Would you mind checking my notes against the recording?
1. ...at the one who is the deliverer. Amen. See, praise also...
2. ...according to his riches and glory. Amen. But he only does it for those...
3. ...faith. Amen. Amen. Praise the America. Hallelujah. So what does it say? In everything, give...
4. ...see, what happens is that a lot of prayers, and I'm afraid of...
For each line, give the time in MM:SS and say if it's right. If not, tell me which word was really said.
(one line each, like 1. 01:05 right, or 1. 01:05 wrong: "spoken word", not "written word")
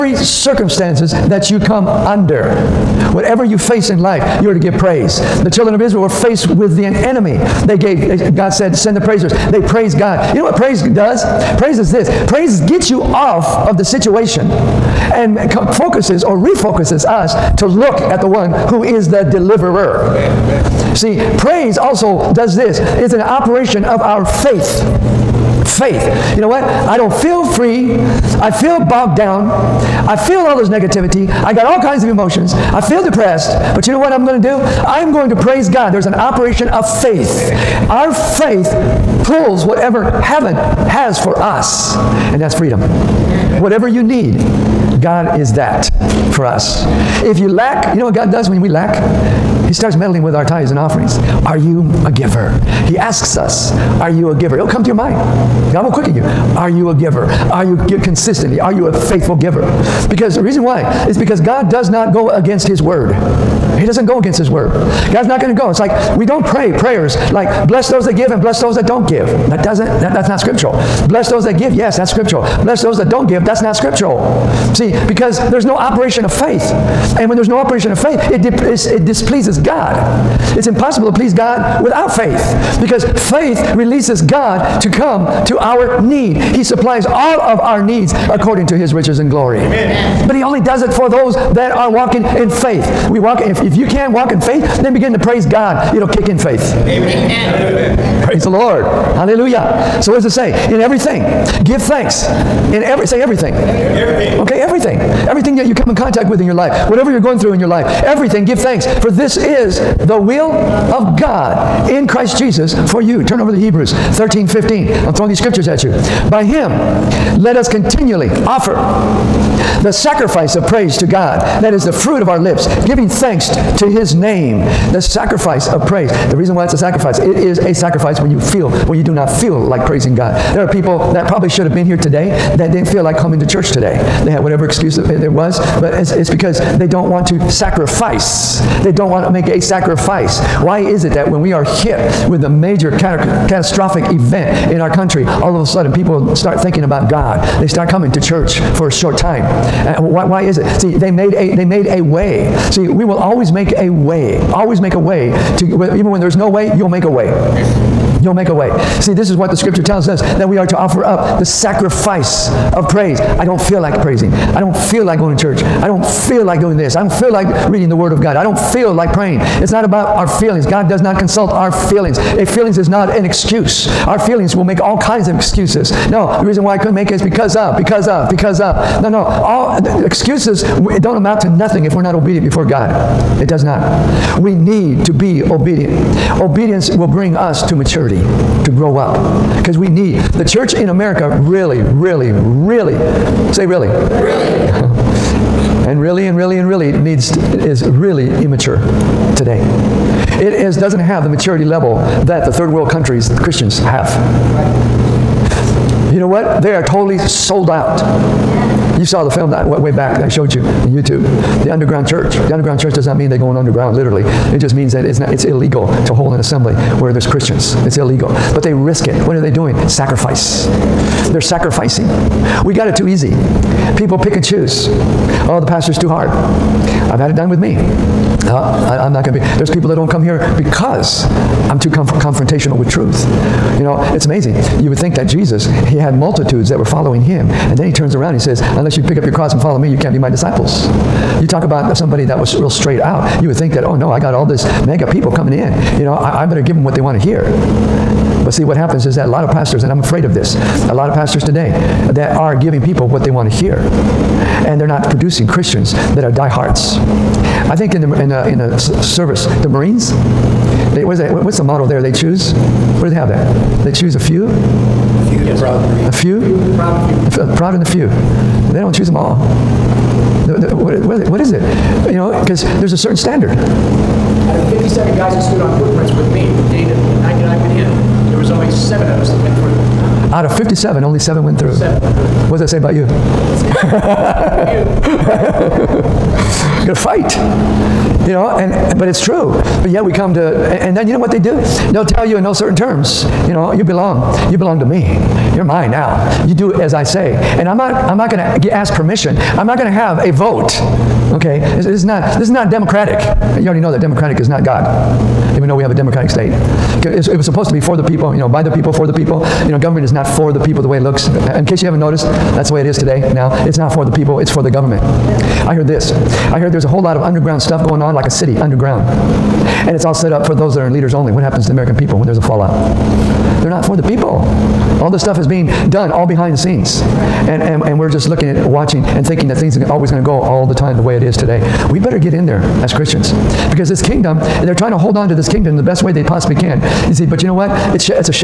1. 00:17 right
2. 01:28 right
3. 01:36 wrong: "Lord", not "America"
4. 04:08 wrong: "pastors", not "prayers".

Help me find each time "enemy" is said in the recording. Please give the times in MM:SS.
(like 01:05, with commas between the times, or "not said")
00:06.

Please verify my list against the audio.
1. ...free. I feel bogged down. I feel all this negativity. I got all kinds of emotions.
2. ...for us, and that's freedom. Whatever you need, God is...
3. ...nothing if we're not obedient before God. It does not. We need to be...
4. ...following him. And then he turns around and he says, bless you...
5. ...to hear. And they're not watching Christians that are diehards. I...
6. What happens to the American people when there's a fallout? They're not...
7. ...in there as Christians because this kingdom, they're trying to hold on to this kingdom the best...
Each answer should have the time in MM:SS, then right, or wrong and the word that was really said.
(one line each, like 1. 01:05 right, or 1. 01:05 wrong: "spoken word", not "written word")
1. 00:27 right
2. 00:41 right
3. 03:01 right
4. 03:56 wrong: "unless", not "bless"
5. 04:13 wrong: "producing", not "watching"
6. 05:21 right
7. 05:32 right.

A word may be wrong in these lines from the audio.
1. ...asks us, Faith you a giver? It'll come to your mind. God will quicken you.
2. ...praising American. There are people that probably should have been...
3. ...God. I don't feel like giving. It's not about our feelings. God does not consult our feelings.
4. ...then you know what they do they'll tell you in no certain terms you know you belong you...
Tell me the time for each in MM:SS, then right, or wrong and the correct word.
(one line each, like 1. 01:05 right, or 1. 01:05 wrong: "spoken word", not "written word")
1. 00:52 wrong: "Are", not "Faith"
2. 02:09 wrong: "God", not "American"
3. 02:48 wrong: "praying", not "giving"
4. 04:50 right.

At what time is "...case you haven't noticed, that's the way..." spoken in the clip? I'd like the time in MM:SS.
05:11.